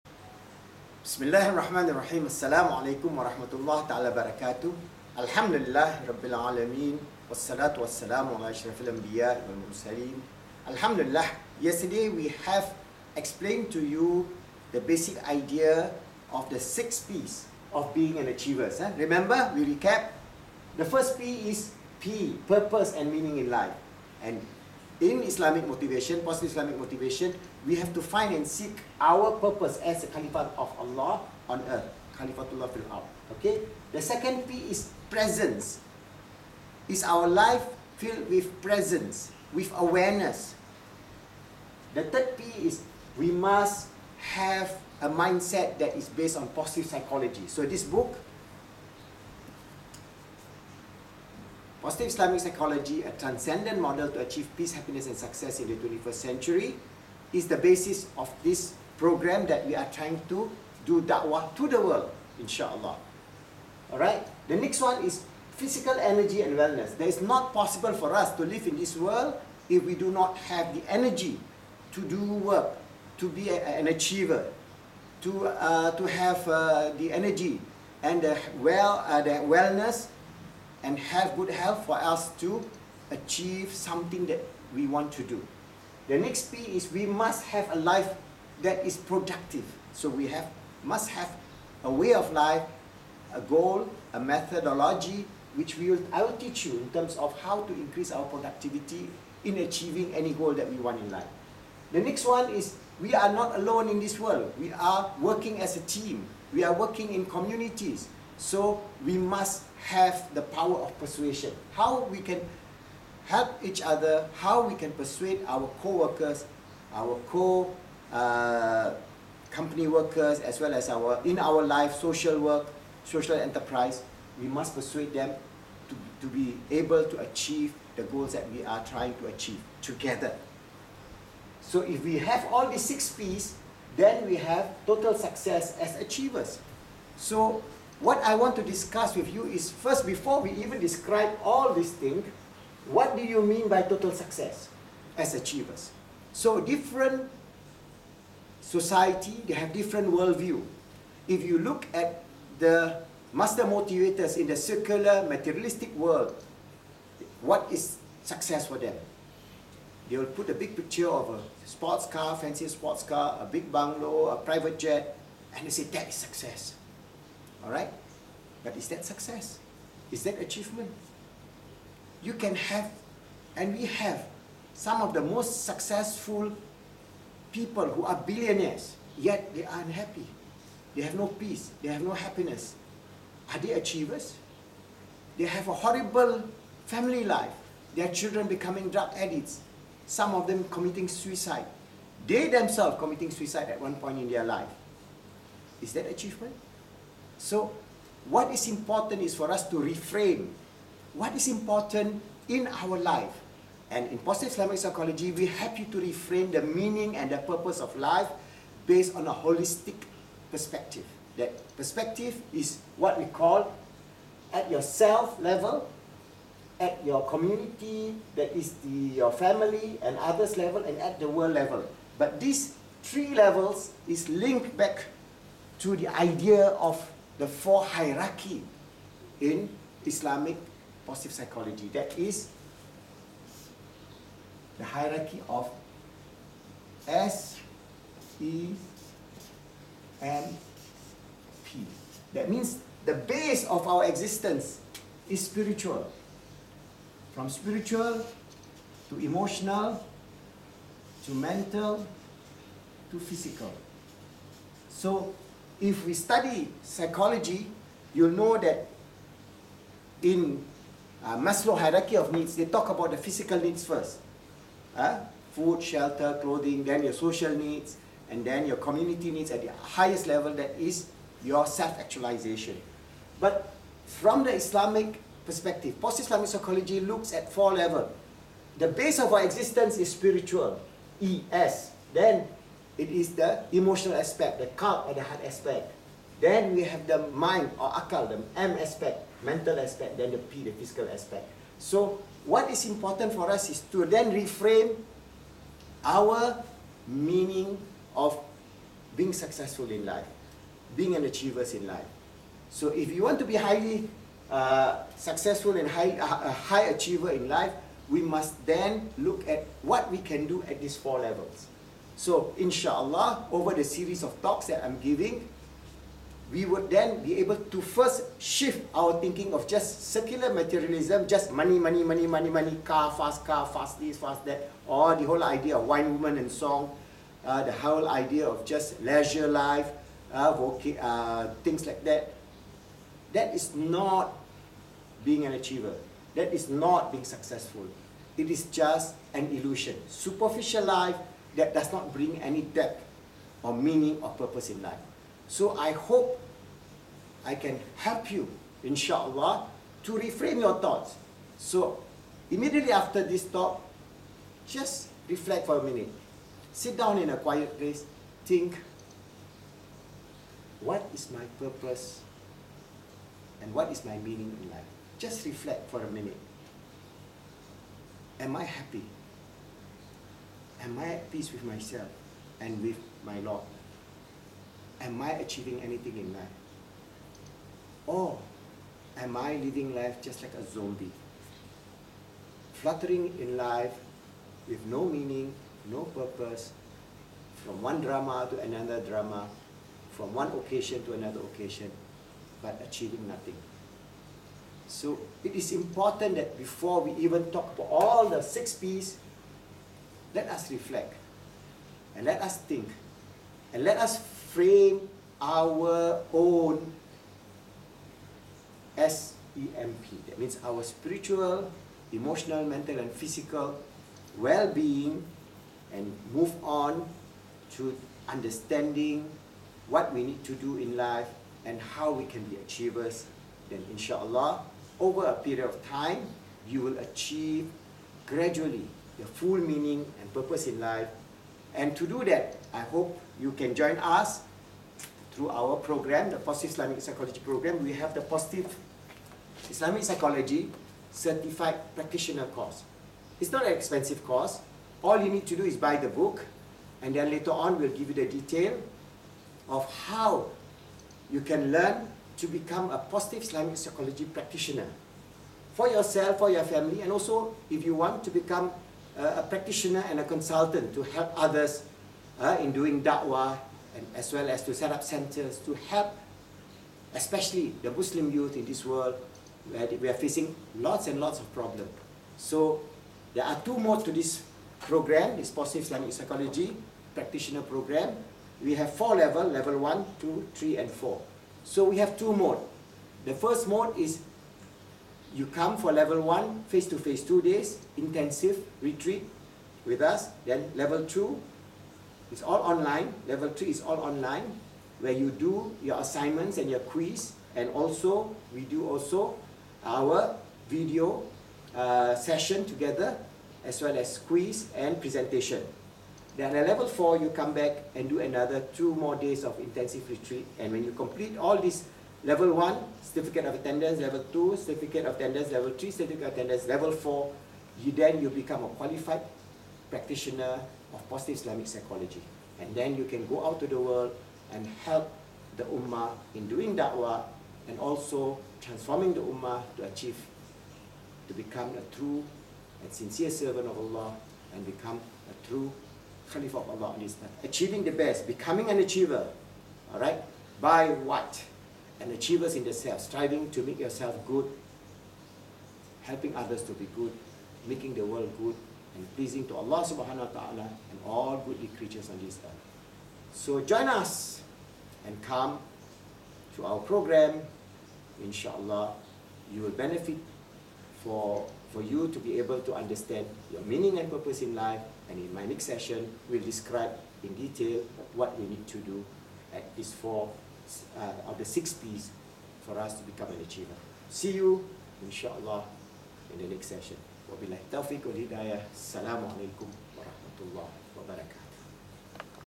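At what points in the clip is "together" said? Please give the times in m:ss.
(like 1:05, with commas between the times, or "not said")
2:09, 8:22.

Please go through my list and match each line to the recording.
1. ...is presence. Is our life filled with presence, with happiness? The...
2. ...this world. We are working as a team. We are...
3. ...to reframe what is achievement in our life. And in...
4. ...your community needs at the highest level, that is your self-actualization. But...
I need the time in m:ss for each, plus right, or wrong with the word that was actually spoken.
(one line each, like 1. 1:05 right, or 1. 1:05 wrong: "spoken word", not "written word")
1. 0:34 wrong: "awareness", not "happiness"
2. 1:43 right
3. 3:19 wrong: "important", not "achievement"
4. 4:28 right.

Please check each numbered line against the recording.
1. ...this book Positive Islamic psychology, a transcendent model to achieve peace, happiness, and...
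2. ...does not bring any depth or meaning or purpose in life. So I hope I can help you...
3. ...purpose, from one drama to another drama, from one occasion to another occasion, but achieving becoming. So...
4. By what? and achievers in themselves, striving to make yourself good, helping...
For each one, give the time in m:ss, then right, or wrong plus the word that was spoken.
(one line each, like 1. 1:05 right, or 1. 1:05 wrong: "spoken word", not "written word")
1. 0:47 right
2. 5:41 right
3. 6:26 wrong: "nothing", not "becoming"
4. 9:00 right.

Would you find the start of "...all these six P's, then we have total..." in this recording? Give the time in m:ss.
2:12.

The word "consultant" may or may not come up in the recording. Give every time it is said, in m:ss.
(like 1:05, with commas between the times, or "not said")
7:40.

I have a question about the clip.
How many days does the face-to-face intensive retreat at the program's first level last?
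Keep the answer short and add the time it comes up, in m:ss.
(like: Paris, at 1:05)
2, at 8:07.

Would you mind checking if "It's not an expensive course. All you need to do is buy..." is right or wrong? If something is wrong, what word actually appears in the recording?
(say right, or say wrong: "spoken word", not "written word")
right.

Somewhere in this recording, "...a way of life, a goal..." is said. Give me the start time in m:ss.
1:31.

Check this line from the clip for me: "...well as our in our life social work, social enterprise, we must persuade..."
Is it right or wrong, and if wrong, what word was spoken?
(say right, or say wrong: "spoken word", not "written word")
right.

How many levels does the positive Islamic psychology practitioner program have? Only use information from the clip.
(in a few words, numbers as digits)
4.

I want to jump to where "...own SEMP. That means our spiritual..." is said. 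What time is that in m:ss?
6:46.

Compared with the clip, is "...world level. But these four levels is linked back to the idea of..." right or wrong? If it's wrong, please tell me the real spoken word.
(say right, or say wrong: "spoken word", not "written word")
wrong: "three", not "four".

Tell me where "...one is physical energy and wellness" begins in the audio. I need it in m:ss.
1:04.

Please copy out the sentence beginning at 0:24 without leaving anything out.
And in Islamic motivation, positive Islamic motivation, we have to find and seek our purpose as a caliphate of Allah on earth.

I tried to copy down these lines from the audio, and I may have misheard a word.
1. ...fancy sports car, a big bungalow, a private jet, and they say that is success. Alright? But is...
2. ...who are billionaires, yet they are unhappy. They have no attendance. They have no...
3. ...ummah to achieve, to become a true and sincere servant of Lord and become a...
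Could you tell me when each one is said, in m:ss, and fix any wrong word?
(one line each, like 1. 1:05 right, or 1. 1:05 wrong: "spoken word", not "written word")
1. 2:42 right
2. 2:57 wrong: "peace", not "attendance"
3. 8:49 wrong: "Allah", not "Lord".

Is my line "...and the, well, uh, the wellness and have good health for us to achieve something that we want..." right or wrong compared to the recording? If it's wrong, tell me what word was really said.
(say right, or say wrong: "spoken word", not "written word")
right.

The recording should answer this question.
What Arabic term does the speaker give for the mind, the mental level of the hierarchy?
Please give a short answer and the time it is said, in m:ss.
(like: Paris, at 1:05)
Akal, at 4:47.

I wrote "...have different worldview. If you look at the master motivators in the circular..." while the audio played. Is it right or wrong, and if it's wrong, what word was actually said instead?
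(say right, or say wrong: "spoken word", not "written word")
right.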